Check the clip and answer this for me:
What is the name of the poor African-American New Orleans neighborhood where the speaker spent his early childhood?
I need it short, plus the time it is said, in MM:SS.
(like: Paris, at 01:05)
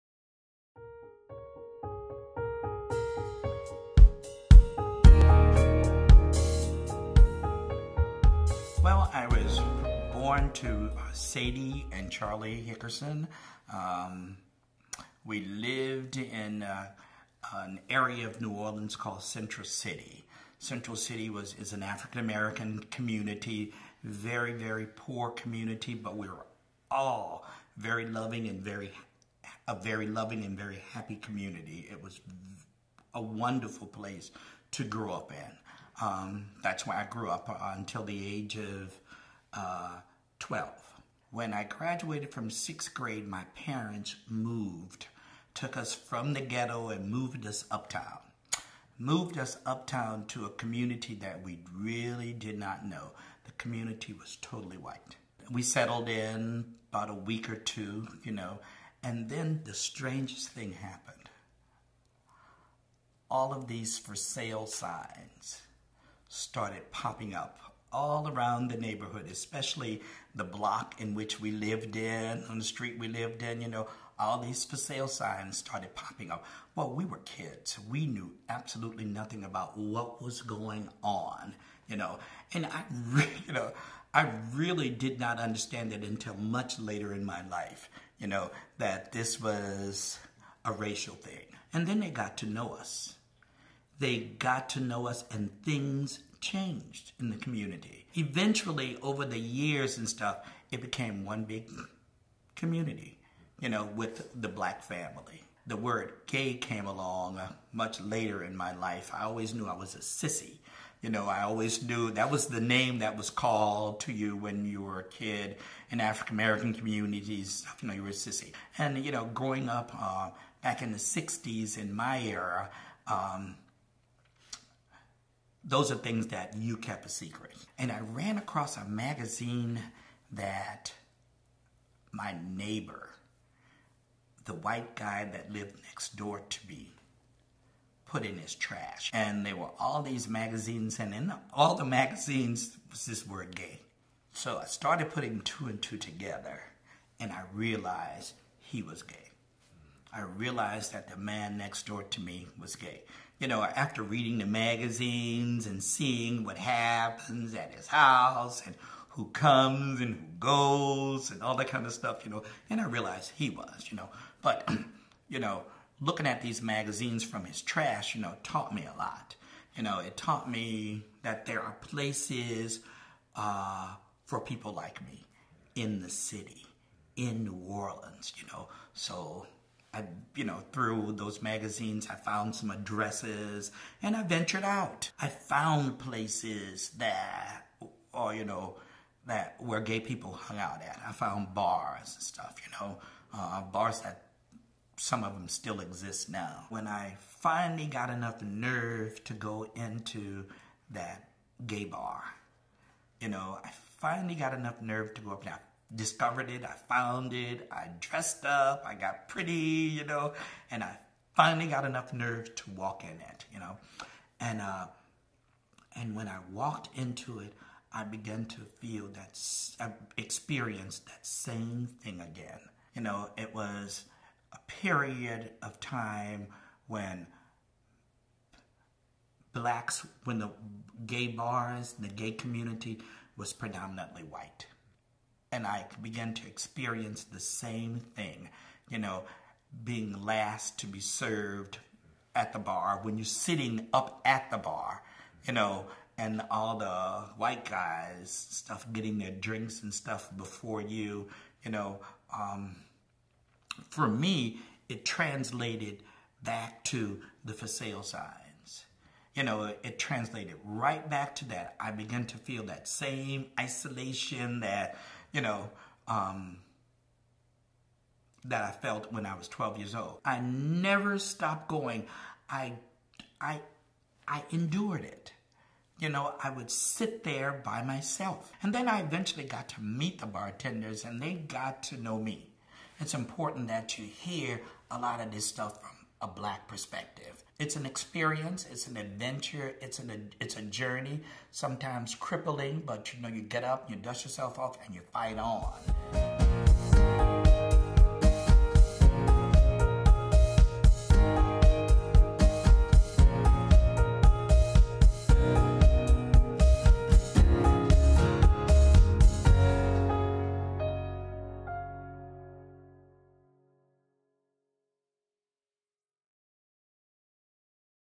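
Central City, at 00:17.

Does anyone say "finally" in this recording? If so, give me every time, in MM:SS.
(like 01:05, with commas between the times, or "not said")
03:17, 03:23, 03:31.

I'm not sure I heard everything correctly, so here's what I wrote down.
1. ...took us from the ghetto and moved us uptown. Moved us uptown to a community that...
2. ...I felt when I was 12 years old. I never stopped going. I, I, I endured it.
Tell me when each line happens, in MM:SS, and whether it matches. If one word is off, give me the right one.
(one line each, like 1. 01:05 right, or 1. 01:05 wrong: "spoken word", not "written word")
1. 00:45 right
2. 04:28 right.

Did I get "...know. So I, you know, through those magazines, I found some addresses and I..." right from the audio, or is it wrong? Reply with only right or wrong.
right.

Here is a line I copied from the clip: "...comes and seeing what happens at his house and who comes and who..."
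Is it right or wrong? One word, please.
wrong.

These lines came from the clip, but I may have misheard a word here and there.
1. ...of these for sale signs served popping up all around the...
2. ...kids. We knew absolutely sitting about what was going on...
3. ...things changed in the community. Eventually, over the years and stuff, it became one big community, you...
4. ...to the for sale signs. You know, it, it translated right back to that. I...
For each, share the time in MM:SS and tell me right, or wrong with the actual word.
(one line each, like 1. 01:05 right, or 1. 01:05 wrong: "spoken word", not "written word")
1. 01:03 wrong: "started", not "served"
2. 01:17 wrong: "nothing", not "sitting"
3. 01:35 right
4. 04:16 right.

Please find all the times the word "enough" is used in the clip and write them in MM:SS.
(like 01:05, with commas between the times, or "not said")
03:18, 03:24, 03:31.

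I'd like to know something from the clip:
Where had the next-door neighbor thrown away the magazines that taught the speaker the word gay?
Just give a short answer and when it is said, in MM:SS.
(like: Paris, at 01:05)
in his trash, at 02:18.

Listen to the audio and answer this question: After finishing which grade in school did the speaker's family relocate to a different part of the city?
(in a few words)
sixth grade.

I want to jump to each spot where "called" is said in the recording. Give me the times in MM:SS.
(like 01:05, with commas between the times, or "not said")
00:18, 01:53.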